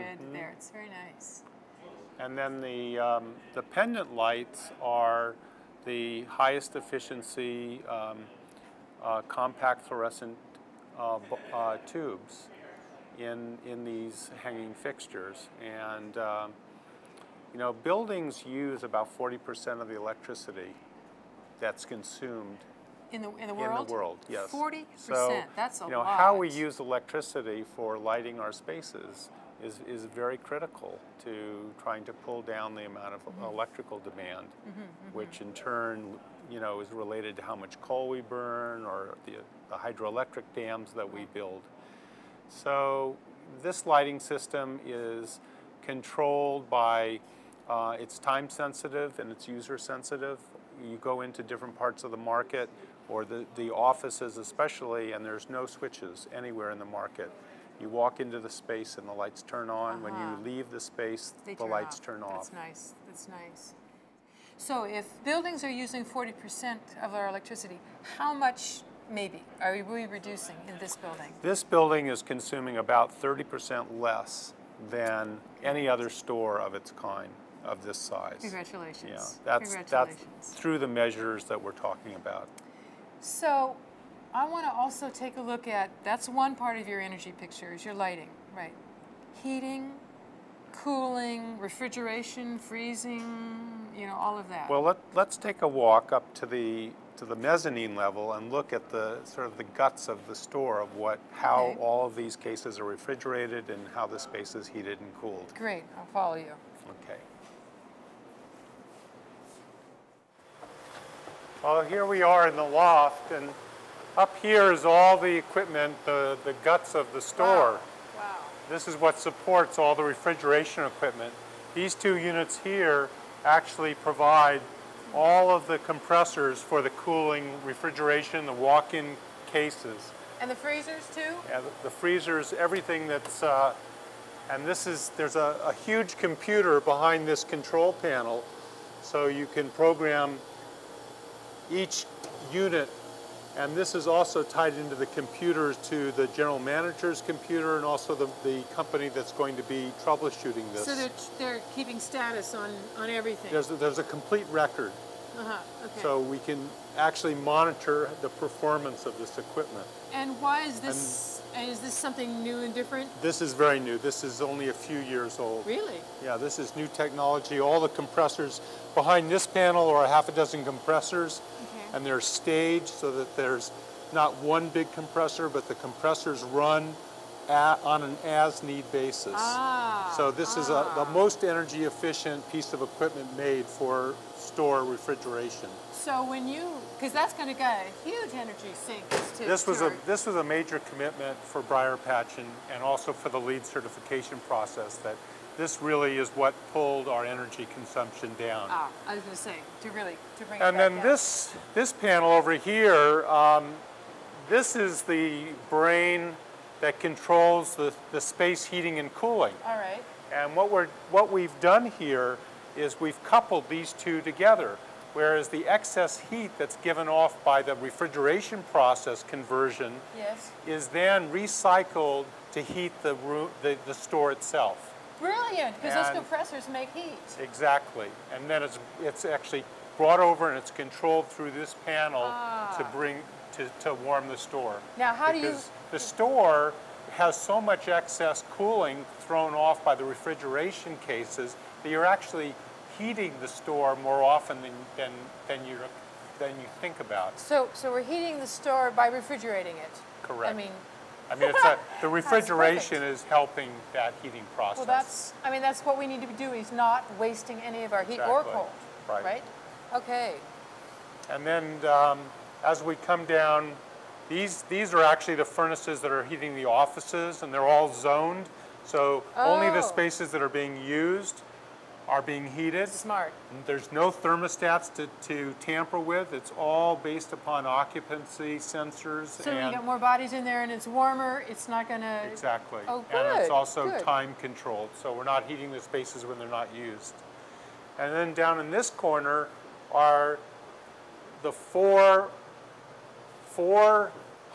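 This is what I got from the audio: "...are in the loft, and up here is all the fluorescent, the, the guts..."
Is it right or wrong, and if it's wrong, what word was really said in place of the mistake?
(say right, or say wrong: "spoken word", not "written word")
wrong: "equipment", not "fluorescent".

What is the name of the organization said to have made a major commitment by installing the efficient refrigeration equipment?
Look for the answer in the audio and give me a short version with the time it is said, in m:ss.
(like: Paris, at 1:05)
BriarPatch, at 3:11.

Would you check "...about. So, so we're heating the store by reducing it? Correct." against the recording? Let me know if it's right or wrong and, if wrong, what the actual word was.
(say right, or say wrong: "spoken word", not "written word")
wrong: "refrigerating", not "reducing".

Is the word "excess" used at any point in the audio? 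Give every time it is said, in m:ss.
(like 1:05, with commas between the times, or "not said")
3:35, 3:57.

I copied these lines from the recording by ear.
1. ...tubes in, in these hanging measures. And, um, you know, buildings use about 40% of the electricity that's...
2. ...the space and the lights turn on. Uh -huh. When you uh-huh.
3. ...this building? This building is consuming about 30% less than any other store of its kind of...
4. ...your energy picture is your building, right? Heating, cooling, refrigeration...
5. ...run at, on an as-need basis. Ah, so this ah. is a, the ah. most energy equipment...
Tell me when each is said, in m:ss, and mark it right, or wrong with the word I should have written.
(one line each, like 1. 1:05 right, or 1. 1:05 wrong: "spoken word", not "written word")
1. 0:11 wrong: "fixtures", not "measures"
2. 0:58 right
3. 1:10 right
4. 1:26 wrong: "lighting", not "building"
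5. 2:56 wrong: "efficient", not "equipment".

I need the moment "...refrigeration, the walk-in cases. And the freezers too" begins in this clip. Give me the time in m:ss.
2:07.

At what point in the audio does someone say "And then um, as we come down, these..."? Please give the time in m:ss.
4:21.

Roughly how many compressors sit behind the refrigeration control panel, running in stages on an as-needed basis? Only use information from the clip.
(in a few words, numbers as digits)
half a dozen.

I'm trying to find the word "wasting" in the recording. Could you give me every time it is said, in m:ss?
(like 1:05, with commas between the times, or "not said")
4:17.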